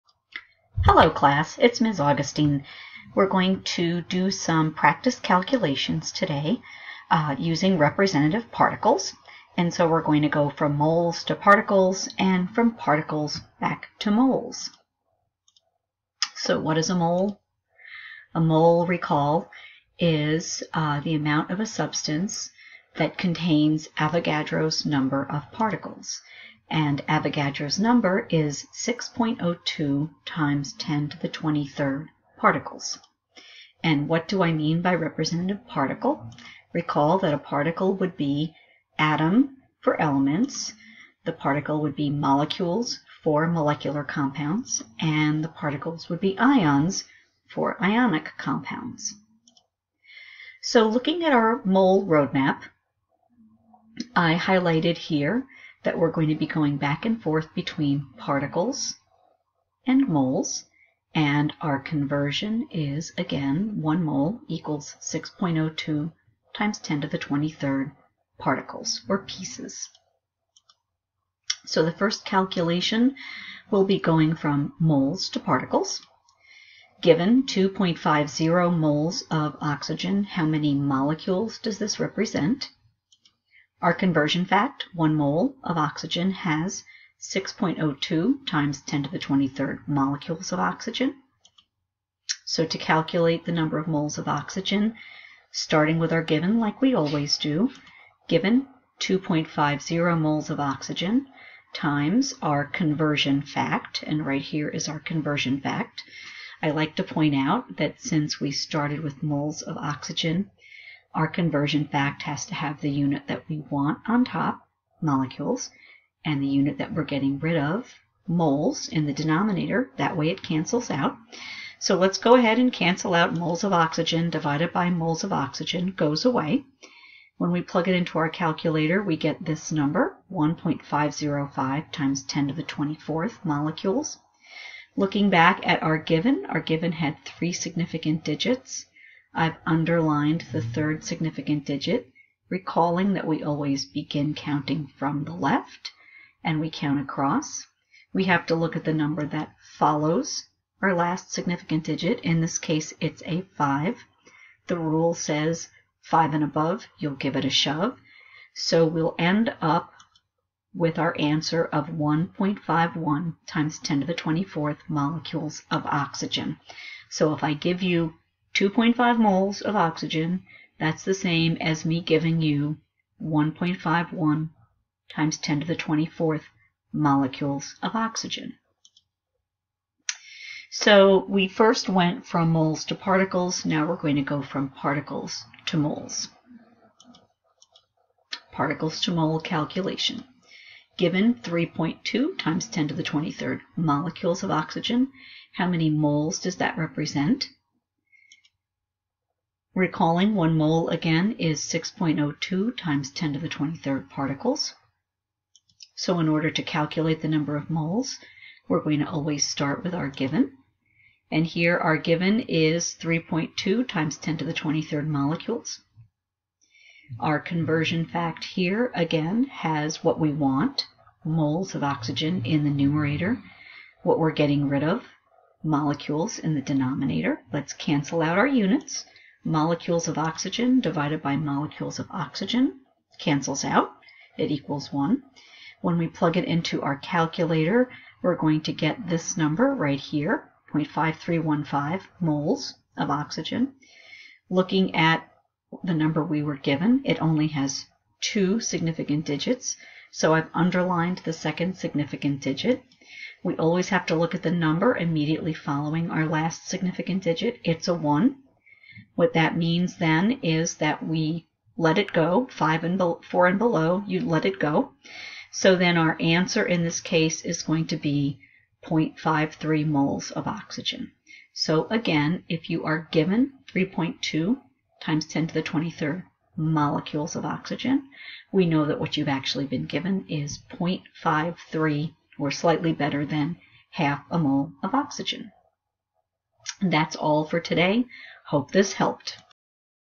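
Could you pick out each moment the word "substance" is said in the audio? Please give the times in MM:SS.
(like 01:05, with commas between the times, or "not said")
00:21.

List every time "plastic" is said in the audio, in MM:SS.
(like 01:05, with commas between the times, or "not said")
not said.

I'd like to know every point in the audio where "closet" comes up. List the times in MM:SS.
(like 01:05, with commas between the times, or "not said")
not said.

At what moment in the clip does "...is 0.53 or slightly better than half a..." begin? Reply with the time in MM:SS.
04:40.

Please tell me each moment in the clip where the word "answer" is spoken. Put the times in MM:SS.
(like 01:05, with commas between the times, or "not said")
02:41, 04:26.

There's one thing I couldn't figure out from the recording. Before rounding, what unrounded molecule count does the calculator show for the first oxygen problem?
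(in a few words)
1.505 times 10 to the 24th.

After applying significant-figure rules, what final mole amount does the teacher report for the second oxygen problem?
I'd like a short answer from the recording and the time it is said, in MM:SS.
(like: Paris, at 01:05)
0.53 moles, at 04:28.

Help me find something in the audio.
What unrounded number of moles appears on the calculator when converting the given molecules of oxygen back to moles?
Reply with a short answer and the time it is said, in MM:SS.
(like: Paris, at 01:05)
0.5315, at 04:00.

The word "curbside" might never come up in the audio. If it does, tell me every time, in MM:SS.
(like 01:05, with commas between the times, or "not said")
not said.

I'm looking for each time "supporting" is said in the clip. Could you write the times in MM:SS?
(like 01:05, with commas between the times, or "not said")
not said.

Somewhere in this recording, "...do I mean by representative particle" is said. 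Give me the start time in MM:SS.
00:34.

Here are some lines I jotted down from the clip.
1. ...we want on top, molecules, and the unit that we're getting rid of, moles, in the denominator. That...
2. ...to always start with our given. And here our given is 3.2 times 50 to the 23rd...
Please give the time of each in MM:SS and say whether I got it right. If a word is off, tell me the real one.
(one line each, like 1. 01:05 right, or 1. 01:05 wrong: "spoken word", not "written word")
1. 01:53 right
2. 03:28 wrong: "10", not "50".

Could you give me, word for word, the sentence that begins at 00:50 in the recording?
So looking at our mole roadmap, I highlighted here that we're going to be going back and forth between particles and moles.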